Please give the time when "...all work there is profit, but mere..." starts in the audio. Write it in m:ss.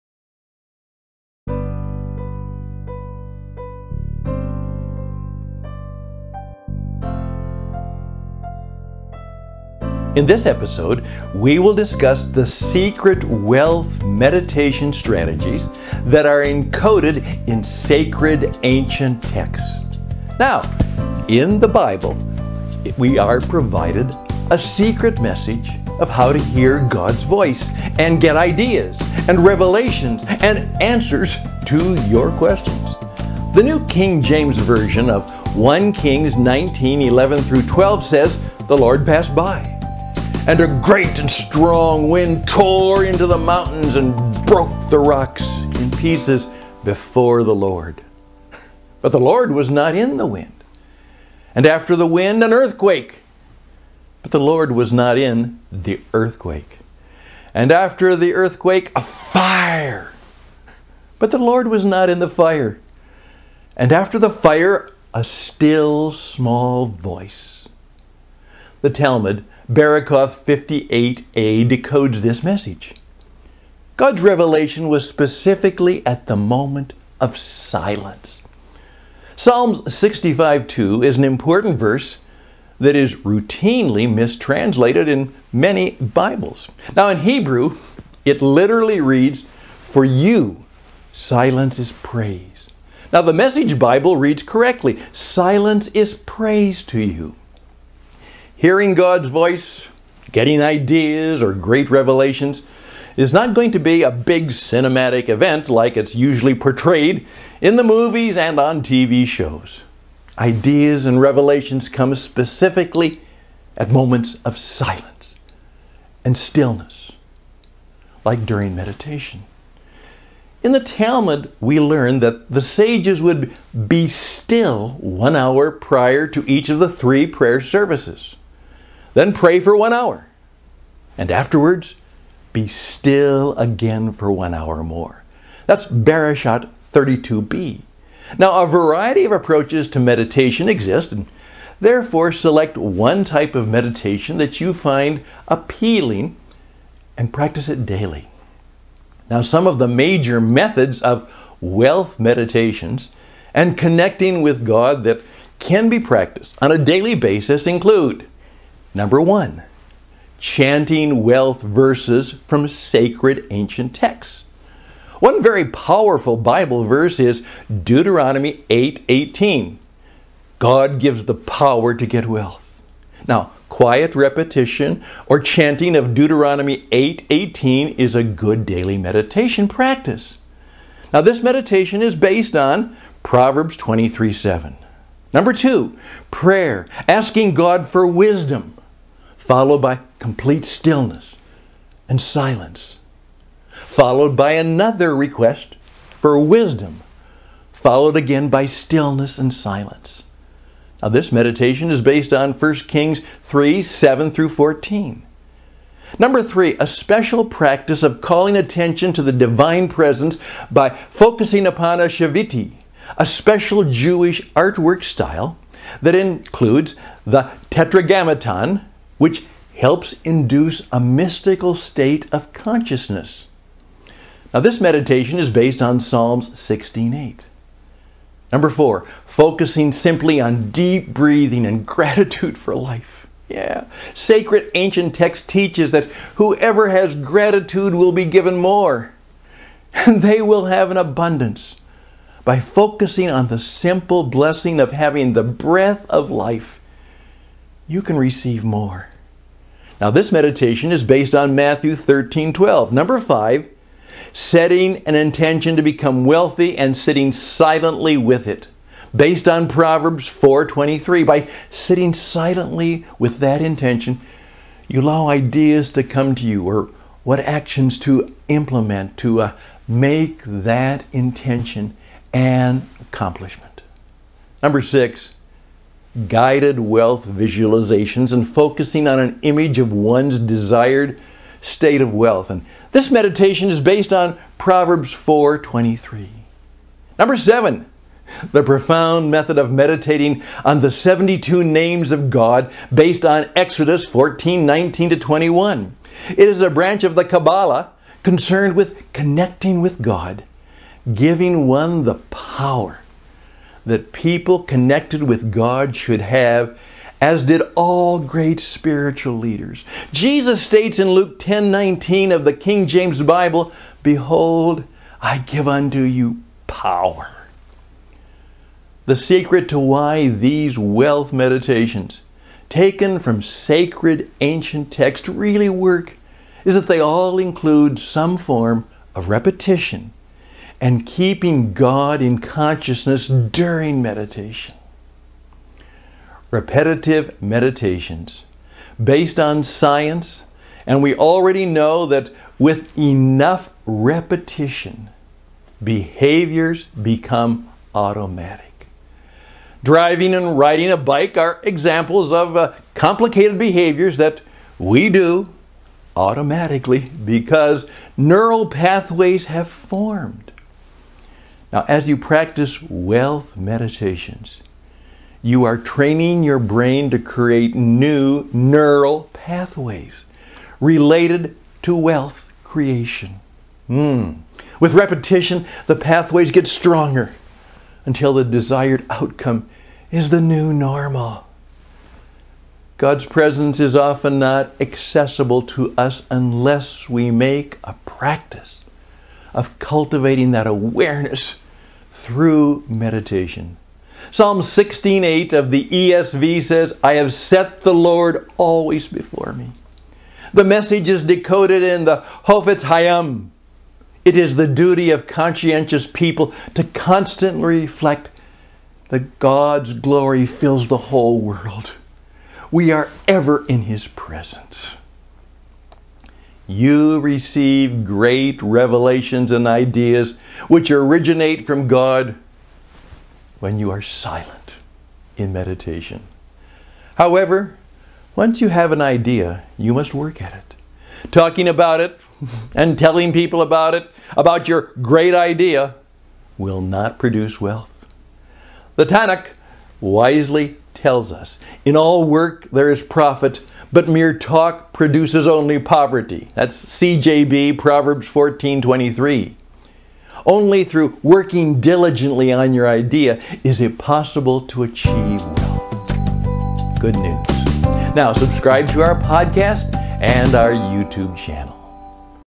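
7:21.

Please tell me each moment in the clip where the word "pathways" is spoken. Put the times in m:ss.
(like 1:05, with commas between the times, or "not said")
5:58, 6:09, 6:15.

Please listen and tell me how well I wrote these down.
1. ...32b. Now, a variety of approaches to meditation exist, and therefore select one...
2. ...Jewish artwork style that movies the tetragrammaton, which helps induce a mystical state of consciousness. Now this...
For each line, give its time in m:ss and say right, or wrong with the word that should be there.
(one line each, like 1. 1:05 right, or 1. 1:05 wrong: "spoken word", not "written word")
1. 2:16 right
2. 3:33 wrong: "includes", not "movies".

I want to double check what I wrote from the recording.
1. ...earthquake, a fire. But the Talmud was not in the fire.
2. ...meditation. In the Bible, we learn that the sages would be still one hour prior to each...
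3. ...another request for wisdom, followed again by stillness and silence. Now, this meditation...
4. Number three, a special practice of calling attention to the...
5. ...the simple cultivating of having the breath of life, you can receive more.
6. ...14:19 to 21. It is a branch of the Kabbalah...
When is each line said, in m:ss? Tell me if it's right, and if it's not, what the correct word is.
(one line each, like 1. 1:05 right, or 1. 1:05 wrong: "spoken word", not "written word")
1. 0:58 wrong: "Lord", not "Talmud"
2. 1:58 wrong: "Talmud", not "Bible"
3. 3:14 right
4. 3:26 right
5. 4:03 wrong: "blessing", not "cultivating"
6. 4:54 right.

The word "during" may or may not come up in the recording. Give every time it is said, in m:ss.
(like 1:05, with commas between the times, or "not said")
1:58, 5:33.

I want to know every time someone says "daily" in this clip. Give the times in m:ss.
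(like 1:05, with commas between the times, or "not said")
2:27, 2:36, 2:58.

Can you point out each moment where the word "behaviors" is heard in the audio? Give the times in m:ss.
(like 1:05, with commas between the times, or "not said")
5:45, 5:53.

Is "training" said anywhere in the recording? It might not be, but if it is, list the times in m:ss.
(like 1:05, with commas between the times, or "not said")
6:05.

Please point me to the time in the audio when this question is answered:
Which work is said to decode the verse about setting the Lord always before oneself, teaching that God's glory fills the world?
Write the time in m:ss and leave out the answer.
6:42.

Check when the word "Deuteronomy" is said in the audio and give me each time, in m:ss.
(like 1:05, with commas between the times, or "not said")
2:47, 2:56.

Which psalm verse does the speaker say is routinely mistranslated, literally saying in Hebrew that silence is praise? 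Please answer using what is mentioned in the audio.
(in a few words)
Psalms 65:2.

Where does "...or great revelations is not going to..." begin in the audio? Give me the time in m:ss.
1:41.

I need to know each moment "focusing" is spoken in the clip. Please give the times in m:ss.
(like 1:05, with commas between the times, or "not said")
3:30, 3:49, 4:02, 4:38.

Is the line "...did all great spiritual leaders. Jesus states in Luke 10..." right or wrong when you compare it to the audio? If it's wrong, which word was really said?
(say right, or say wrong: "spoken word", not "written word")
right.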